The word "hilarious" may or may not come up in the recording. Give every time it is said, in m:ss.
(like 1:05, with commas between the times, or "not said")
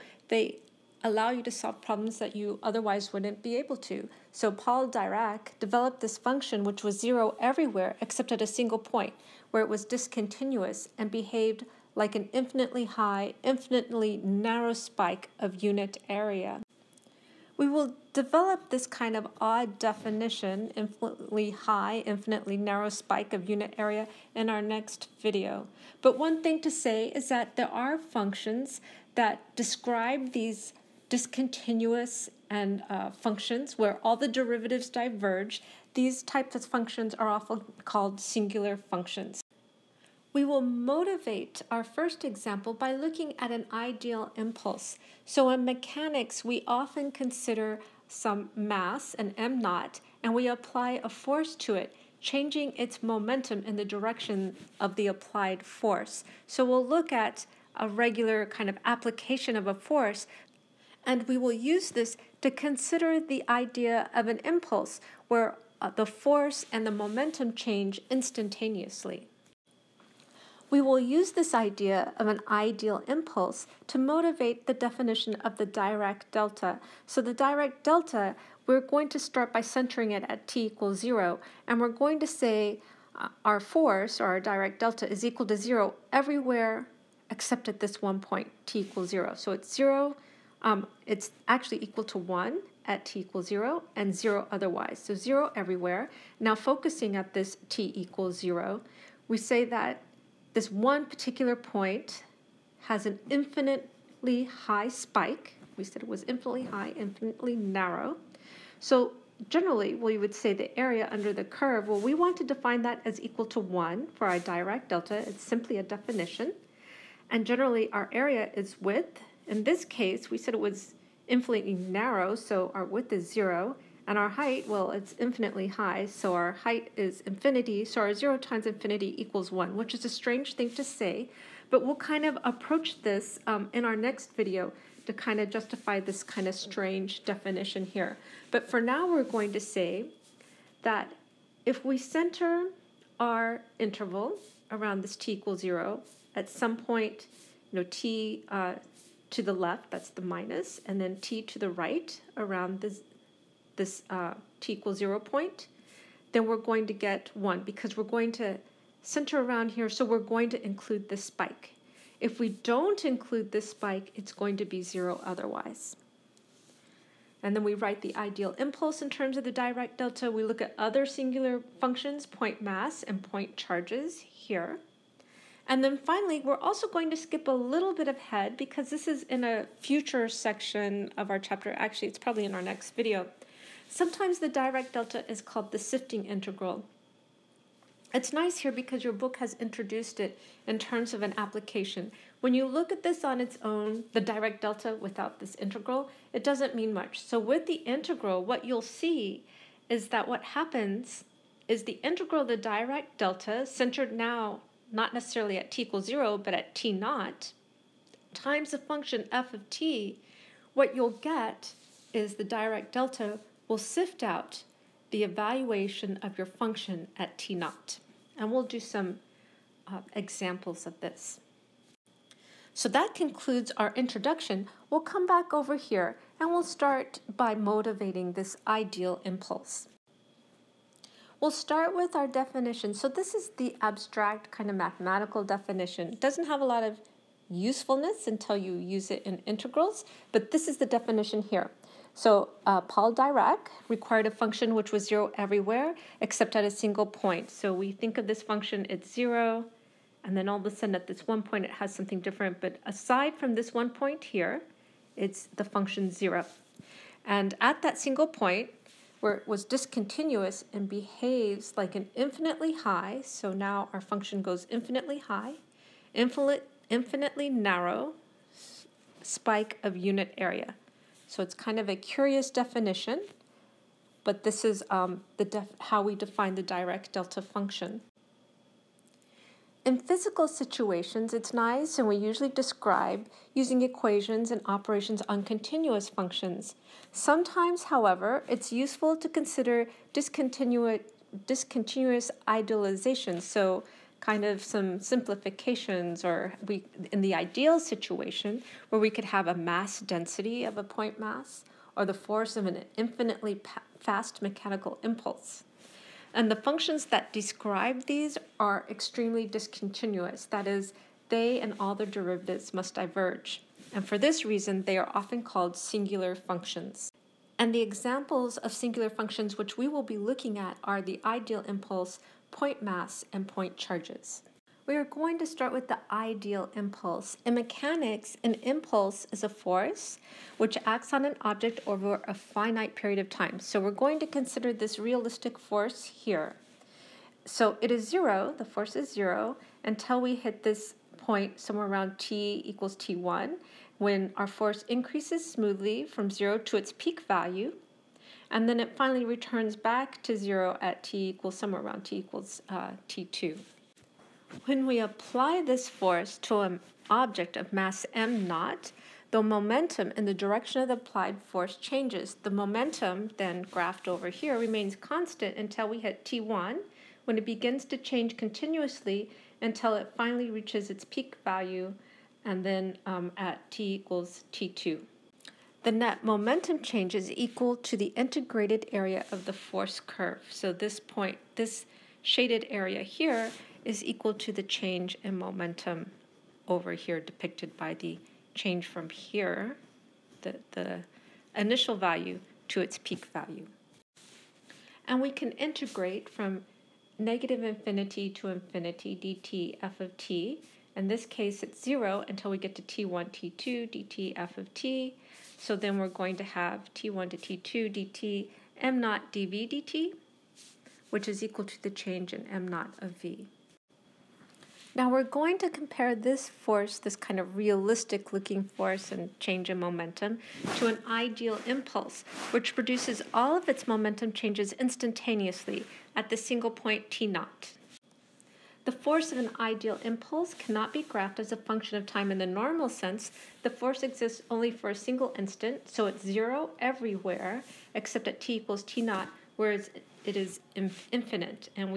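not said.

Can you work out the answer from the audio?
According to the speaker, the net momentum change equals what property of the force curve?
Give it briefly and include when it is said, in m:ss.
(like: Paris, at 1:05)
integrated area, at 6:18.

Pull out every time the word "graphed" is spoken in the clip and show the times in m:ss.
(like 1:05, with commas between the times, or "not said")
6:03, 7:11.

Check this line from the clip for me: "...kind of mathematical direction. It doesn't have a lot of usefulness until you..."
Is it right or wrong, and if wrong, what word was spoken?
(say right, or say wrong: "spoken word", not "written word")
wrong: "definition", not "direction".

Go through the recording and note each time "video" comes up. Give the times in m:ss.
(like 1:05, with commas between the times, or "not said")
0:25, 2:14, 3:02.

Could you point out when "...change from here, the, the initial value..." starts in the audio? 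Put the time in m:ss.
6:28.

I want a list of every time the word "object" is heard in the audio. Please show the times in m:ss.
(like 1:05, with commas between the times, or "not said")
5:31, 5:57.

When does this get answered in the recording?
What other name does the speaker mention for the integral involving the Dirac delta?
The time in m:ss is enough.
3:05.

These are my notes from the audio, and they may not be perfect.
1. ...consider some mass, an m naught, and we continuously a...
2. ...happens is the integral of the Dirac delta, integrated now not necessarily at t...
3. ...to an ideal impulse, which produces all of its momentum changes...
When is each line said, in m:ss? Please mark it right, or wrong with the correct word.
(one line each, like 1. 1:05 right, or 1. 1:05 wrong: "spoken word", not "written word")
1. 0:47 wrong: "apply", not "continuously"
2. 3:20 wrong: "centered", not "integrated"
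3. 7:00 right.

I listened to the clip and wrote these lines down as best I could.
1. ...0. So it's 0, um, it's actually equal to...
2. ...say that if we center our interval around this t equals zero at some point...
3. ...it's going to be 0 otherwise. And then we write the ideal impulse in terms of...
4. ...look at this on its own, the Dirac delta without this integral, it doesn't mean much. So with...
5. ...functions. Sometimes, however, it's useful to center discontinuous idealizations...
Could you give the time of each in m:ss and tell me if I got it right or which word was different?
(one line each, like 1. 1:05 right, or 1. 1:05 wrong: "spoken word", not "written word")
1. 1:29 right
2. 2:19 right
3. 2:44 right
4. 3:12 right
5. 4:46 wrong: "consider", not "center".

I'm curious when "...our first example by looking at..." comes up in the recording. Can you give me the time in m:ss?
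0:41.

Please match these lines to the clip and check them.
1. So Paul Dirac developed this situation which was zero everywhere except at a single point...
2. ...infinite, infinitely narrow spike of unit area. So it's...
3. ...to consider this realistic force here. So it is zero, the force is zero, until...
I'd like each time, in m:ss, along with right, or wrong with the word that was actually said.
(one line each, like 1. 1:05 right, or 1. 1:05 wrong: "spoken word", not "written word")
1. 0:04 wrong: "function", not "situation"
2. 4:26 right
3. 5:34 right.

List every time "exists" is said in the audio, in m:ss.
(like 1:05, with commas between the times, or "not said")
7:14.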